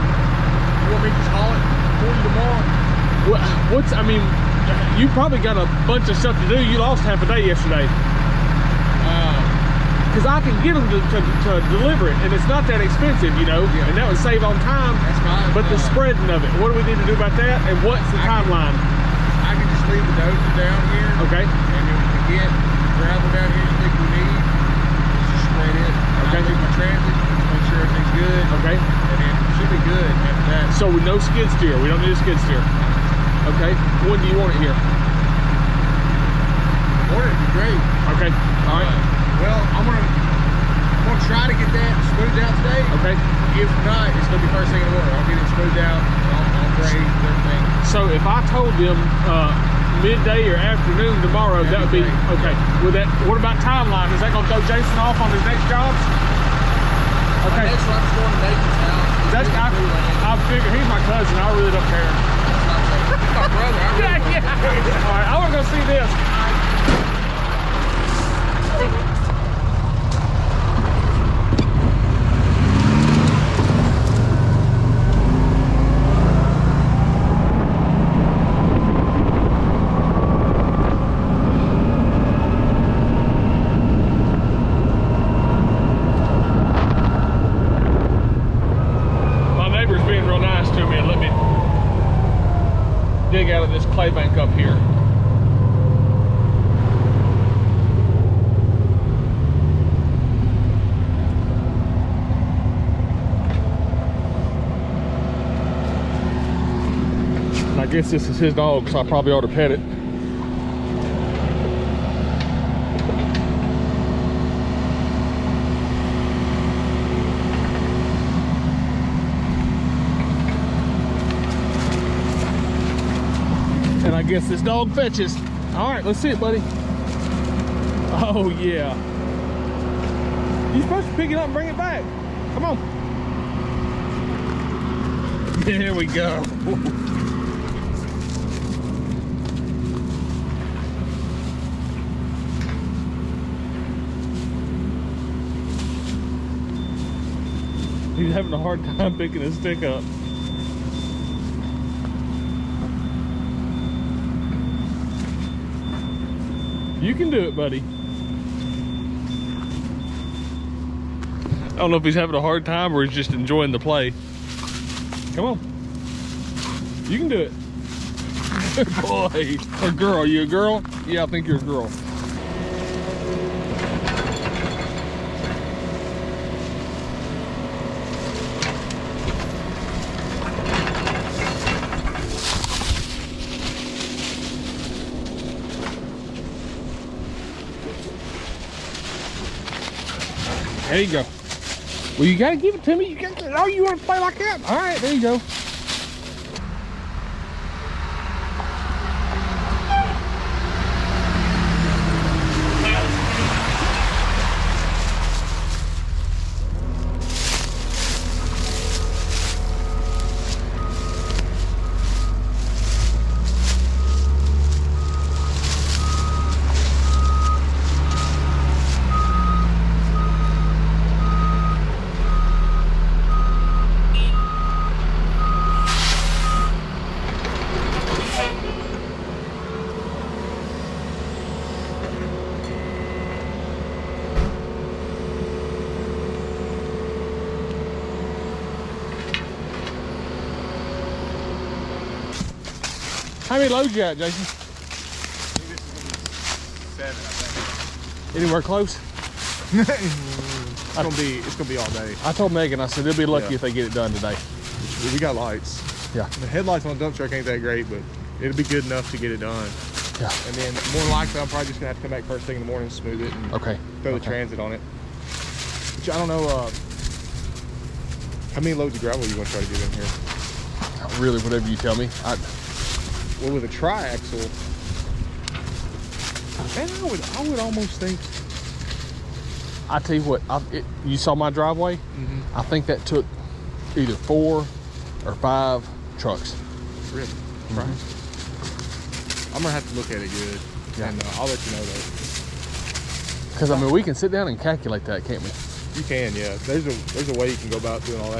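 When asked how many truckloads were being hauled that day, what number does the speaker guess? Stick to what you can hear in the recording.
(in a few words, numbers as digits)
7.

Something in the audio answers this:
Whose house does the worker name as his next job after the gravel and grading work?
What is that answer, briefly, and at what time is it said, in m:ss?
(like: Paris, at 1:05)
Nathan's, at 0:58.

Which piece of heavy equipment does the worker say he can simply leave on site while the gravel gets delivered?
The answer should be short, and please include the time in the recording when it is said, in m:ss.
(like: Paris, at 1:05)
dozer, at 0:20.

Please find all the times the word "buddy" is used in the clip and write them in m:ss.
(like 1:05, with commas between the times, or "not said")
2:06, 2:37.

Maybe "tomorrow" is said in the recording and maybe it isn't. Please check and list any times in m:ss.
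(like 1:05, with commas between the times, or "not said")
0:02, 0:51.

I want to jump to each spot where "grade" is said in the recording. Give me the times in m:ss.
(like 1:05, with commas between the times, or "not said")
0:46.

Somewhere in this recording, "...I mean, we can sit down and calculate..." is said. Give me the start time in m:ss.
4:53.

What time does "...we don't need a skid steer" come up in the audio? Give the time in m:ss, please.
0:31.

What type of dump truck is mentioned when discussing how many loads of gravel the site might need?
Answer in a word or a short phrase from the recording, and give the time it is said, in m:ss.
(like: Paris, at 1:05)
triaxle, at 4:33.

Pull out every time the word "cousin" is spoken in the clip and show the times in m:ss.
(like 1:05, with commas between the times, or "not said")
1:01.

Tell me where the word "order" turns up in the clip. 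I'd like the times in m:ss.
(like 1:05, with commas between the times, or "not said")
0:37, 0:45.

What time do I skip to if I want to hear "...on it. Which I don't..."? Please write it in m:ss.
4:24.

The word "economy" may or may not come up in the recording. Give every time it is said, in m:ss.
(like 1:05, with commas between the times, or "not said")
not said.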